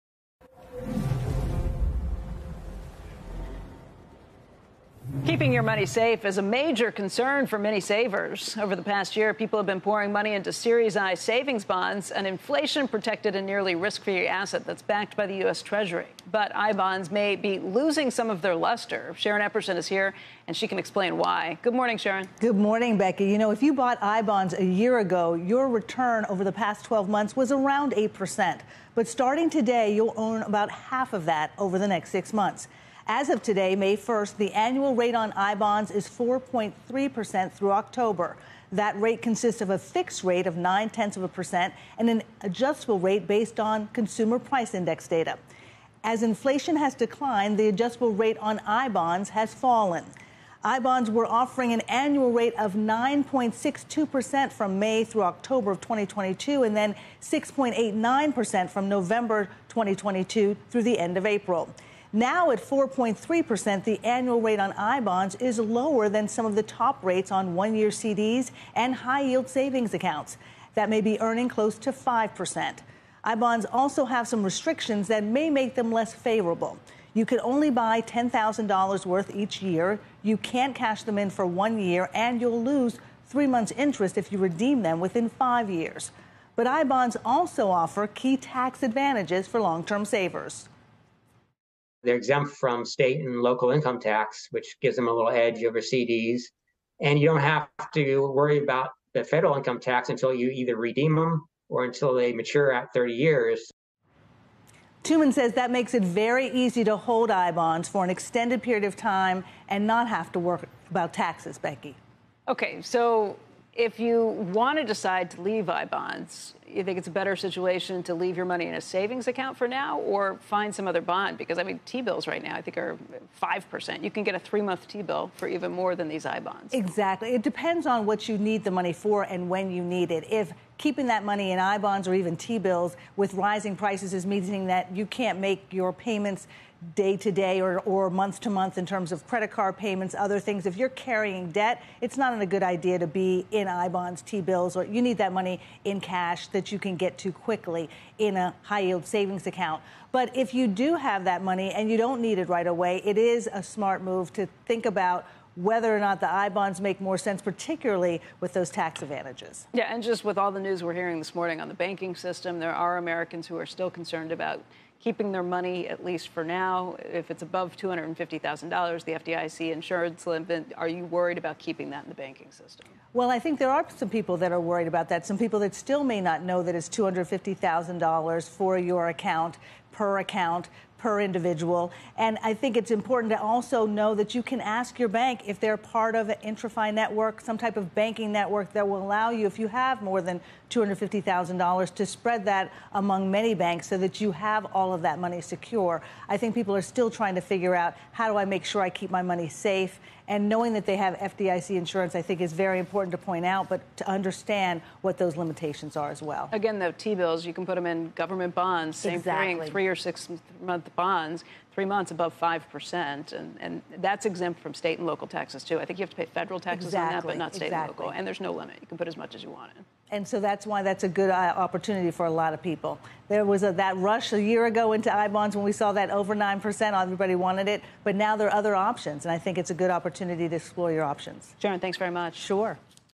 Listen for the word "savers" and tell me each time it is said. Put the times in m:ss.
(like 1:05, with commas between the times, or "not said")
0:07, 1:30.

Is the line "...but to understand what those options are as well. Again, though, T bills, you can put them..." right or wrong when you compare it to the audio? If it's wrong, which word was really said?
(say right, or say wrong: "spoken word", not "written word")
wrong: "limitations", not "options".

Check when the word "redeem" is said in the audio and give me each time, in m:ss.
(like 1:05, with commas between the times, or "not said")
1:24, 1:40.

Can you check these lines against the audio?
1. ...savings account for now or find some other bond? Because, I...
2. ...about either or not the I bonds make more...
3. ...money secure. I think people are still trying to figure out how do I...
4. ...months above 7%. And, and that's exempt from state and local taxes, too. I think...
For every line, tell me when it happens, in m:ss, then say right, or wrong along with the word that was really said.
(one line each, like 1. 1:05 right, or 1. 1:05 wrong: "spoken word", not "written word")
1. 1:58 right
2. 2:34 wrong: "whether", not "either"
3. 3:15 right
4. 3:31 wrong: "5", not "7".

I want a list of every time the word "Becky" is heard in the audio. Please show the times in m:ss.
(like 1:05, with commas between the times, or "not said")
0:22, 1:51.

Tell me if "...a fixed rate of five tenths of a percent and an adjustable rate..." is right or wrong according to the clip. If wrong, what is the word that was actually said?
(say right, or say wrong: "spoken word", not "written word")
wrong: "nine", not "five".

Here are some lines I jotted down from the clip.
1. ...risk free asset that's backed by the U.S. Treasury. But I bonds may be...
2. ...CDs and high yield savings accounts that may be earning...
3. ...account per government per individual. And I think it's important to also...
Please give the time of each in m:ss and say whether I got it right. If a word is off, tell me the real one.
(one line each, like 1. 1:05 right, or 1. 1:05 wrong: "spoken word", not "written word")
1. 0:13 right
2. 1:07 right
3. 2:59 wrong: "account", not "government".